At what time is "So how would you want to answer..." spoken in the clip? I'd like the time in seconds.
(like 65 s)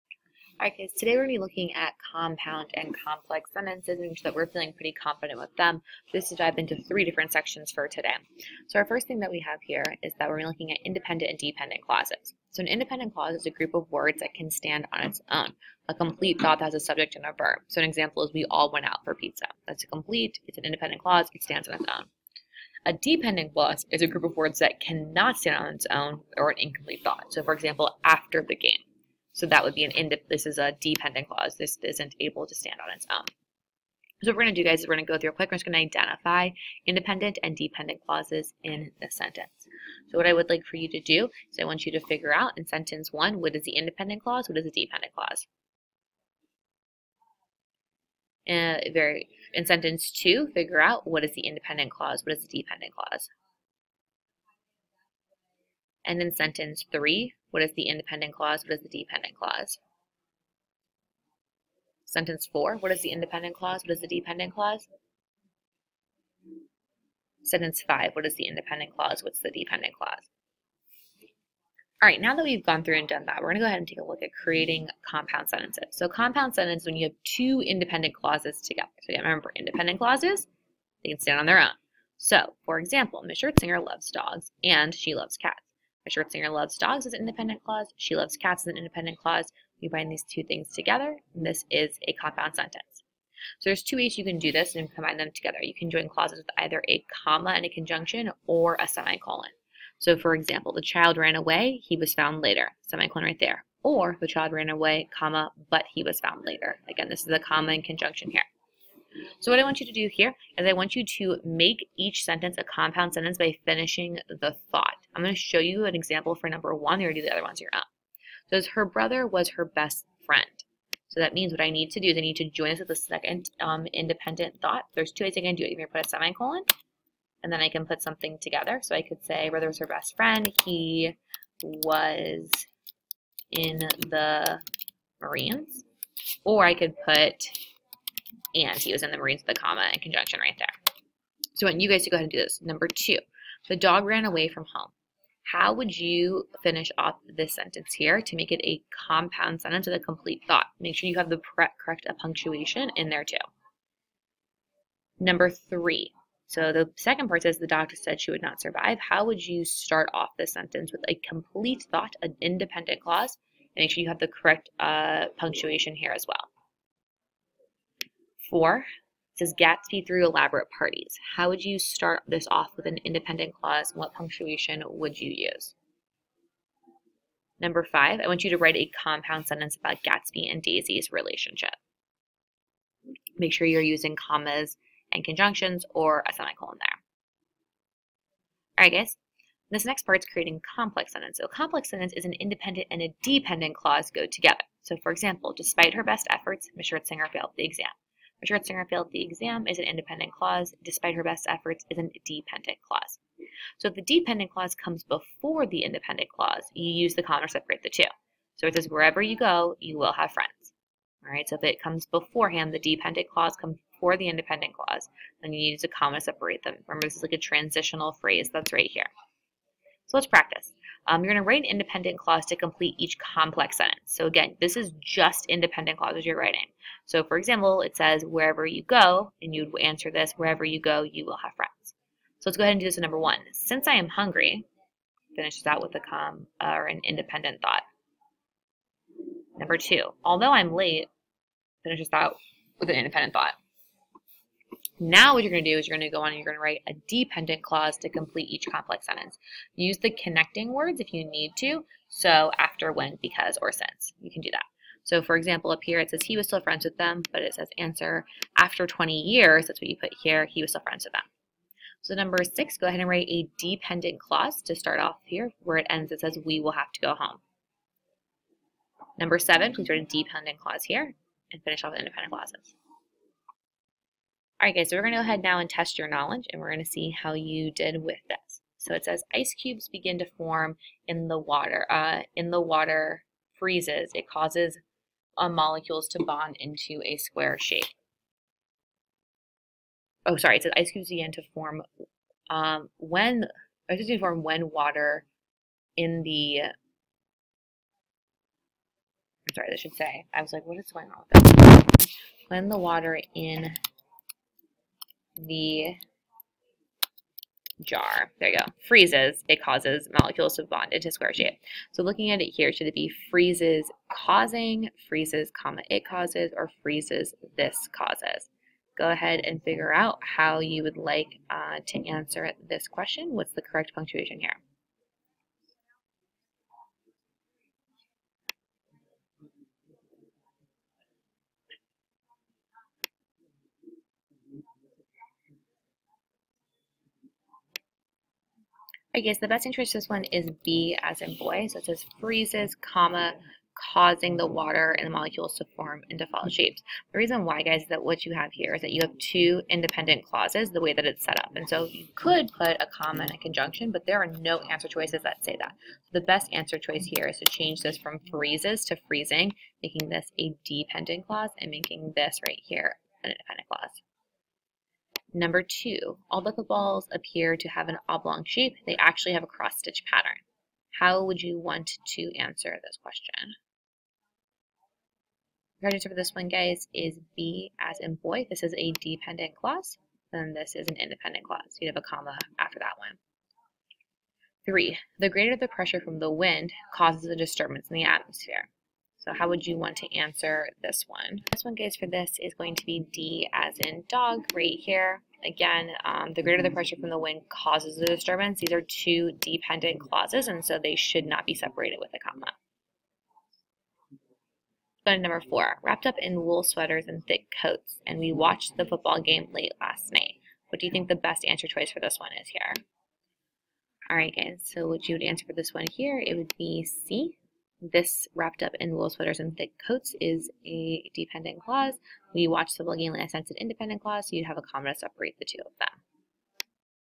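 389 s.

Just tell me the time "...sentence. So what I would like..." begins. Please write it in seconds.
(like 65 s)
39 s.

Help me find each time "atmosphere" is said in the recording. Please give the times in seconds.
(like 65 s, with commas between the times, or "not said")
388 s.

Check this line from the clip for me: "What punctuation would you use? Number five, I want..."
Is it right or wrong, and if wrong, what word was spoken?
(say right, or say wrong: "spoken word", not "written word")
right.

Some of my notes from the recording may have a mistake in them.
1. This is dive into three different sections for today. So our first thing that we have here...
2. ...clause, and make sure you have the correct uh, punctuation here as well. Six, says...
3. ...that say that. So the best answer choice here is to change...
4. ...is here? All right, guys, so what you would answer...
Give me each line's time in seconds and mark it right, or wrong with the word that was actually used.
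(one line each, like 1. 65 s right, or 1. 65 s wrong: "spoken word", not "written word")
1. 6 s right
2. 163 s wrong: "Four", not "Six"
3. 355 s right
4. 412 s right.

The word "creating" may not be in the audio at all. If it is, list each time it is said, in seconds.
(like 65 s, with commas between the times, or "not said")
74 s, 190 s.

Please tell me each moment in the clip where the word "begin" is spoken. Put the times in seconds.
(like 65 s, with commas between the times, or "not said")
279 s, 291 s.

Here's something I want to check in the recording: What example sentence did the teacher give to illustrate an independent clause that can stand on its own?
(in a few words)
We all went out for pizza.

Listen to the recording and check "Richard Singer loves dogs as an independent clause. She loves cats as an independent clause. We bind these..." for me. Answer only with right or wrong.
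right.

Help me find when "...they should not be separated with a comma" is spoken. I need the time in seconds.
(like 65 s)
400 s.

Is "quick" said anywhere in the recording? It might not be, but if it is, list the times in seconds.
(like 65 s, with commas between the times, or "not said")
35 s.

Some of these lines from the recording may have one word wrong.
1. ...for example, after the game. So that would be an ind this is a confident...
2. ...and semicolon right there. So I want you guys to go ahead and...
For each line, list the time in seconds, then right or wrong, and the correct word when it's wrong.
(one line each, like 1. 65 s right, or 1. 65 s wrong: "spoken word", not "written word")
1. 27 s wrong: "dependent", not "confident"
2. 139 s wrong: "conjunction", not "semicolon".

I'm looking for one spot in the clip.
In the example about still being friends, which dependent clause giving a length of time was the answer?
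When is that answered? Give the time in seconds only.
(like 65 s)
258 s.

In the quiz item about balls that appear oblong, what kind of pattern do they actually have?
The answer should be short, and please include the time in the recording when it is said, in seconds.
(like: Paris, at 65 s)
cross-stitch pattern, at 369 s.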